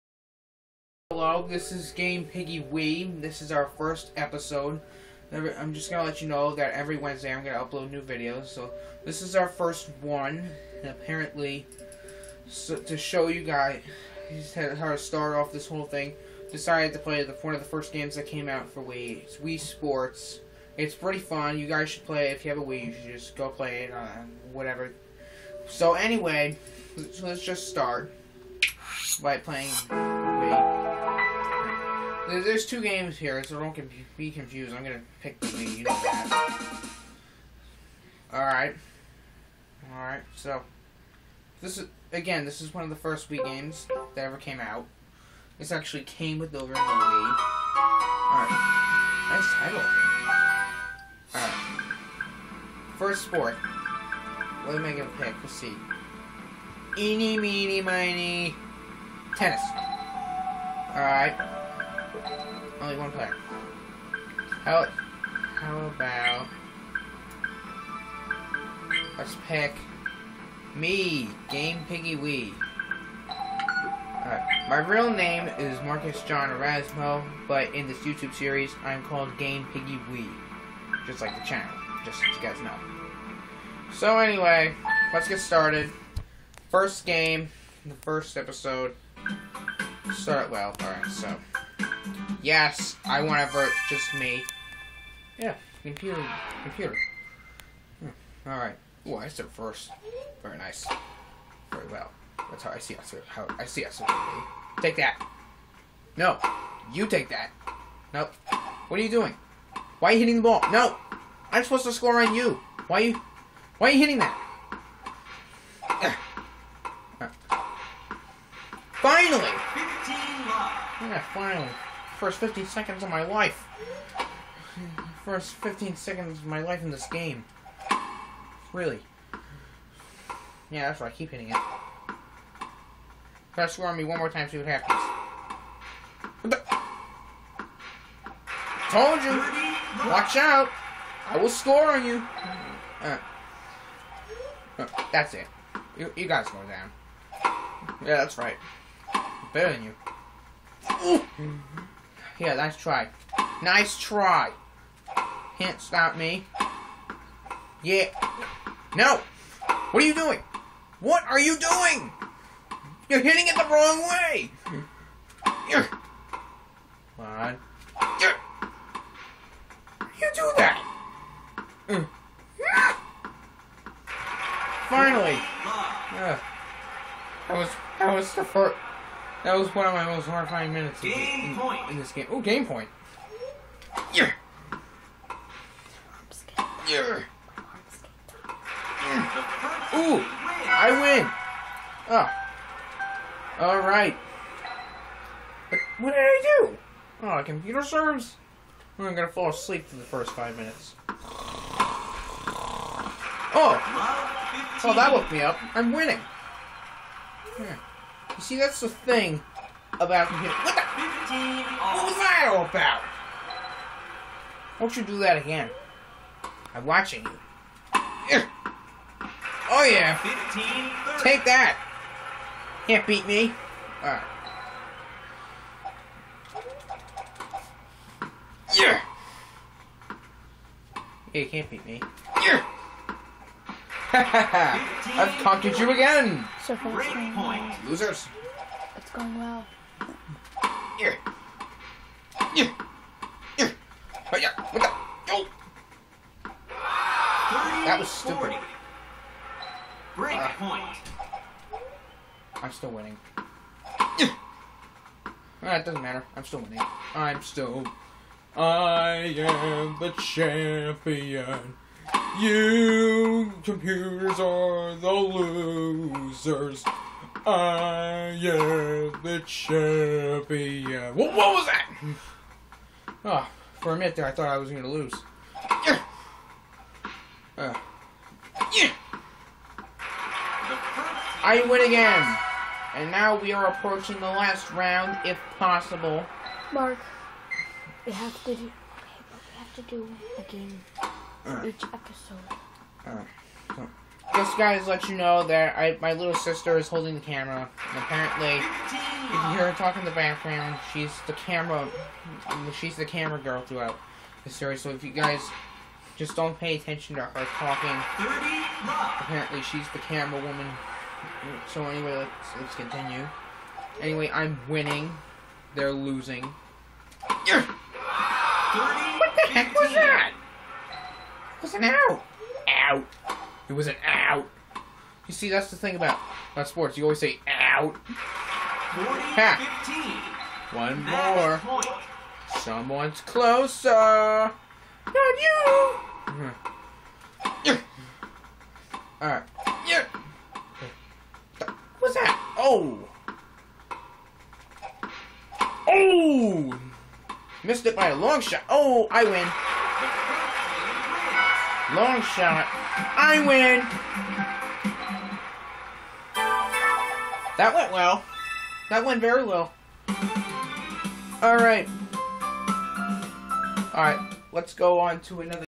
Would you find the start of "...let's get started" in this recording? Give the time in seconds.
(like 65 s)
85 s.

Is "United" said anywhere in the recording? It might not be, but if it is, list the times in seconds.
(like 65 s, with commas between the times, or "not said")
not said.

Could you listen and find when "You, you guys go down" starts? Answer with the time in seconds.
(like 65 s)
145 s.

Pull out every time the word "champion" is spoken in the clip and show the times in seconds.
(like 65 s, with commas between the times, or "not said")
260 s, 269 s.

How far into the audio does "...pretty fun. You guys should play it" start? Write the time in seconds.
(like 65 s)
20 s.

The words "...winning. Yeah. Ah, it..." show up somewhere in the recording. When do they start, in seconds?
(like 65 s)
252 s.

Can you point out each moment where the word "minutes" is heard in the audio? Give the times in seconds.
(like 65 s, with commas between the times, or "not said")
180 s, 200 s, 273 s.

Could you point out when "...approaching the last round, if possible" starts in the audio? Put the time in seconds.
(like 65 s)
283 s.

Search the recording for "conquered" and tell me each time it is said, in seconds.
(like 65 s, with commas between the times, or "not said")
235 s.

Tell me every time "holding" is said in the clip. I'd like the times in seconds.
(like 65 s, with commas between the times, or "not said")
296 s.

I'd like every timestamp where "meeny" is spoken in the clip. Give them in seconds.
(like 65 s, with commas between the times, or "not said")
57 s.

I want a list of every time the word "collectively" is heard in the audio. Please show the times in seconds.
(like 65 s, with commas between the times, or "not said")
not said.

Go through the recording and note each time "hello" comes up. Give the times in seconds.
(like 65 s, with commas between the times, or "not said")
1 s.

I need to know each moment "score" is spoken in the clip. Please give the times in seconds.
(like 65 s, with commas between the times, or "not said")
111 s, 133 s, 141 s.